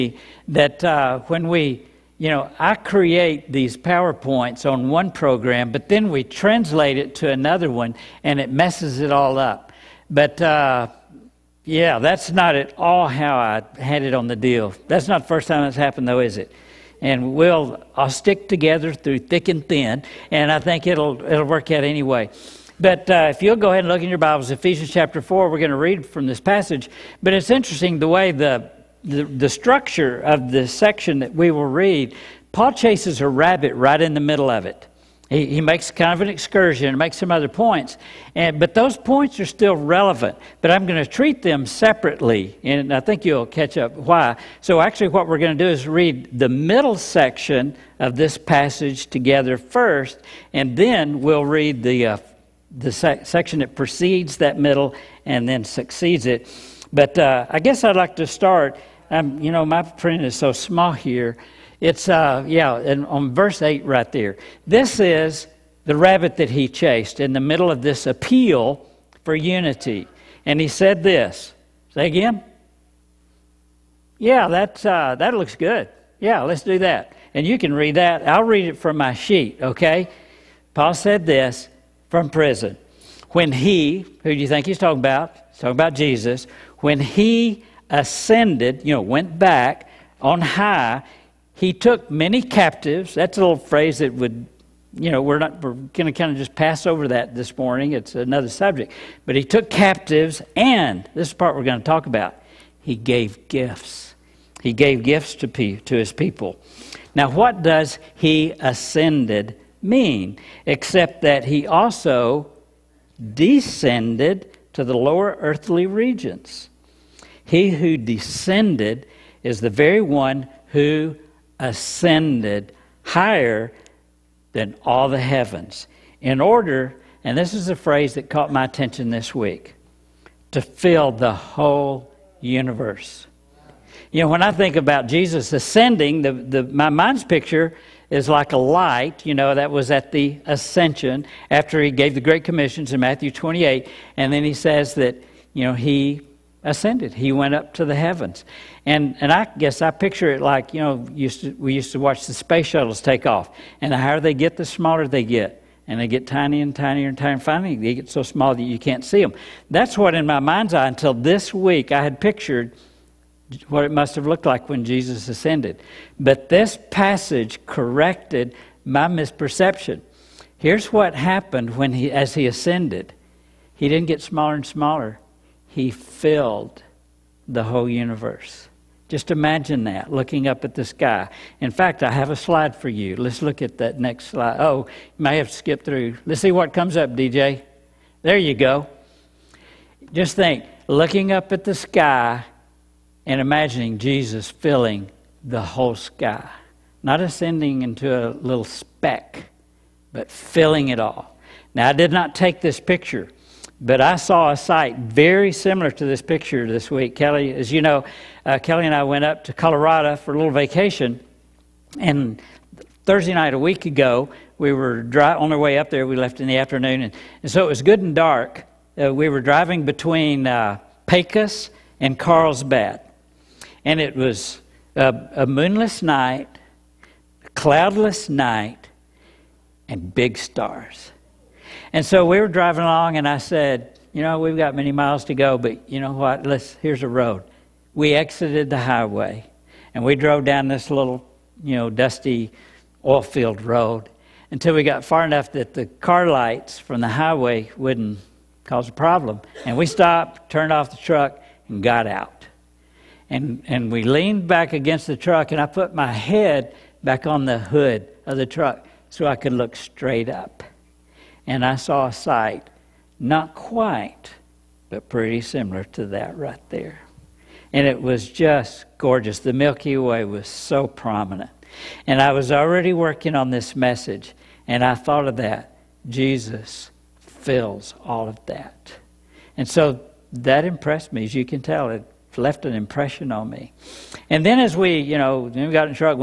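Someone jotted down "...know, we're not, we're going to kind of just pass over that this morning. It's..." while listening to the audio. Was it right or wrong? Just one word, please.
right.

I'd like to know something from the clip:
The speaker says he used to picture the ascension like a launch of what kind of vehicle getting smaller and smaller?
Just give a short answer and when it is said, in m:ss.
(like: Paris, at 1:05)
Space shuttles, at 2:32.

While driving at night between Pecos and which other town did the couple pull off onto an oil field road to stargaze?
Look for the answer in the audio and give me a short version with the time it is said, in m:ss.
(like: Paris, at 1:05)
Carlsbad, at 3:42.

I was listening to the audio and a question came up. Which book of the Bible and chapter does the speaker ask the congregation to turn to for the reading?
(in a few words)
Ephesians 4.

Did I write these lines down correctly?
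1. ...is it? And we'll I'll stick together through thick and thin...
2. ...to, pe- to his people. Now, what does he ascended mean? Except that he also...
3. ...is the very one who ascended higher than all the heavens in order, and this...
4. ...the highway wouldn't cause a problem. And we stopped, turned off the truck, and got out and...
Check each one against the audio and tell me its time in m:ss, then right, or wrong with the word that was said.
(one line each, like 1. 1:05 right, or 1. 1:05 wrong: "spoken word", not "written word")
1. 0:16 right
2. 1:45 right
3. 1:59 right
4. 4:07 right.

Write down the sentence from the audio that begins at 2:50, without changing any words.
Here's what happened when he, as he ascended.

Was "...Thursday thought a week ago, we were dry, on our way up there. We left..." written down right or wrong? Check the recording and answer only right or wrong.
wrong.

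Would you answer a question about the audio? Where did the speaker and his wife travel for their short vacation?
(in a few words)
Colorado.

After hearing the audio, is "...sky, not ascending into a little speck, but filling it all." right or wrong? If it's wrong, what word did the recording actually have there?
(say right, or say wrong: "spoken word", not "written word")
right.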